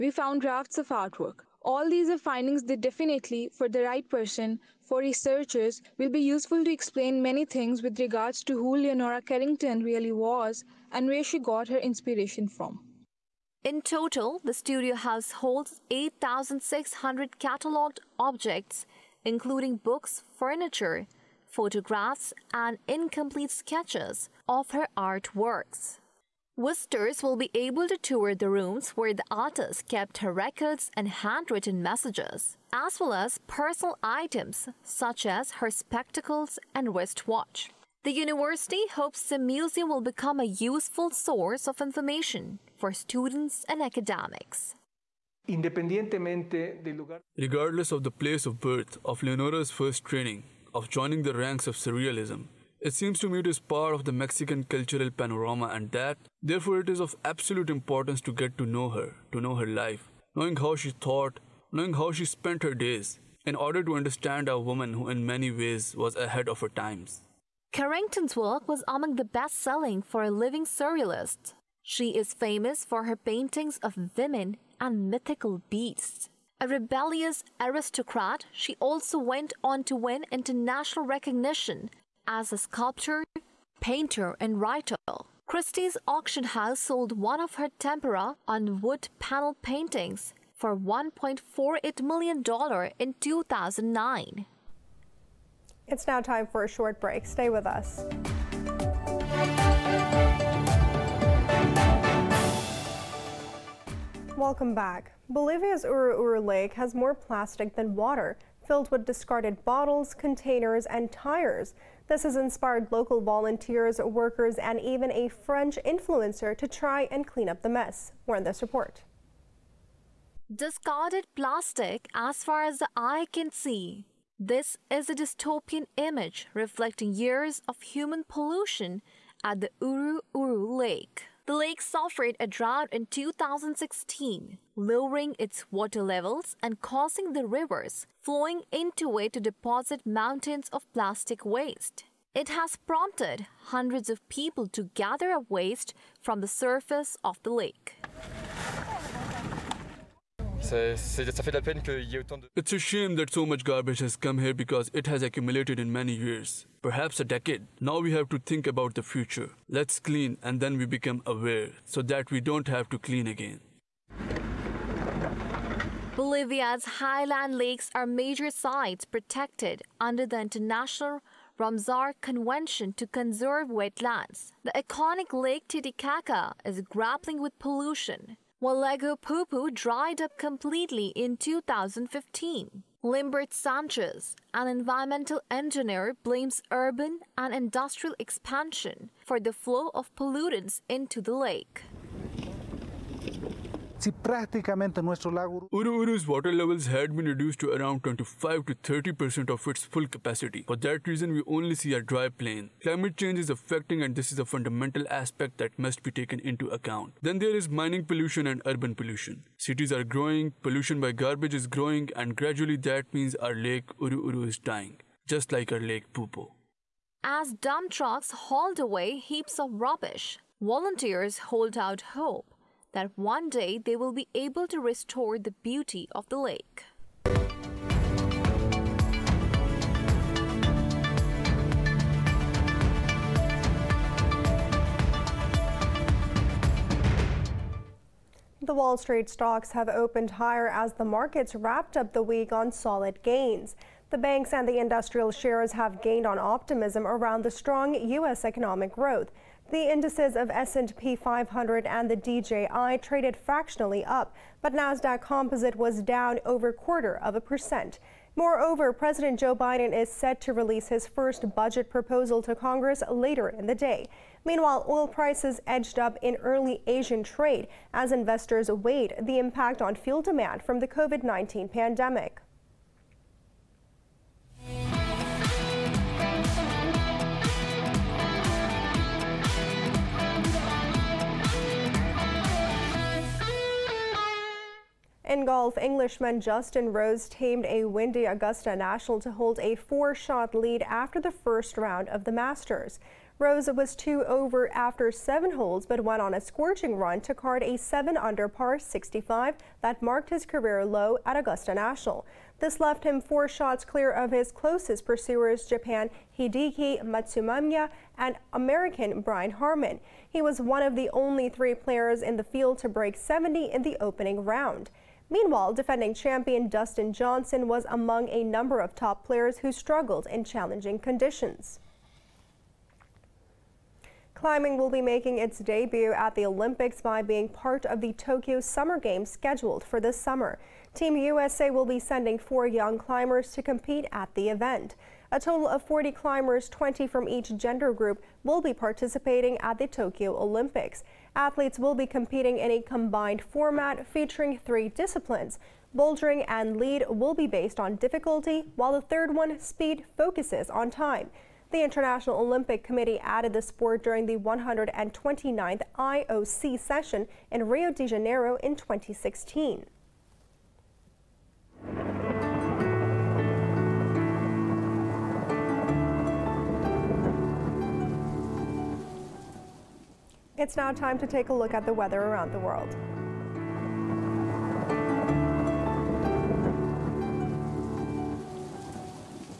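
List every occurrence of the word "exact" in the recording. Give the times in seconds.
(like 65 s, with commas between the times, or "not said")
not said.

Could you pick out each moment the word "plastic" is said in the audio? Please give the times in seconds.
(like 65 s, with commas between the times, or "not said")
107 s, 121 s, 140 s.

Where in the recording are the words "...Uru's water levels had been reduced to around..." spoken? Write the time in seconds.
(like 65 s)
196 s.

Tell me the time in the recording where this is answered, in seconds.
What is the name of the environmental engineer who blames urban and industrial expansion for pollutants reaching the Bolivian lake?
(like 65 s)
183 s.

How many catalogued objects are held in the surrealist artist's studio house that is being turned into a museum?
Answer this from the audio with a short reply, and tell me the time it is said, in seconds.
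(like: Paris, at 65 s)
8,600, at 15 s.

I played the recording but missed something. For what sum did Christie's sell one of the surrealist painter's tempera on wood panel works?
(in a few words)
$1.48 million.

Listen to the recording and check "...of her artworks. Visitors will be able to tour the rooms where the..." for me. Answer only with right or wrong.
right.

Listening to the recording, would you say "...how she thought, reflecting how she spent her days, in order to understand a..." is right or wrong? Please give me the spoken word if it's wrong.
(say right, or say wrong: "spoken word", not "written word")
wrong: "knowing", not "reflecting".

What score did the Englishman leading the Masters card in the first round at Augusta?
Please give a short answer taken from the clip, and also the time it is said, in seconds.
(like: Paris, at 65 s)
7-under par 65, at 297 s.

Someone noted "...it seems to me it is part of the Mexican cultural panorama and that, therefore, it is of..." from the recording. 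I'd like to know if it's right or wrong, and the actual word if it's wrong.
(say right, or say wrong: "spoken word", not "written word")
right.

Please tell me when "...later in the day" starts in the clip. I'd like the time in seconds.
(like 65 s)
263 s.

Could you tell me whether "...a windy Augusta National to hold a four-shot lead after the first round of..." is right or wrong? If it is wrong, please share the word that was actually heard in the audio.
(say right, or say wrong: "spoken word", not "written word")
right.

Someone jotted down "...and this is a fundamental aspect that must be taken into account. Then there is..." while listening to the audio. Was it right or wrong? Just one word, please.
right.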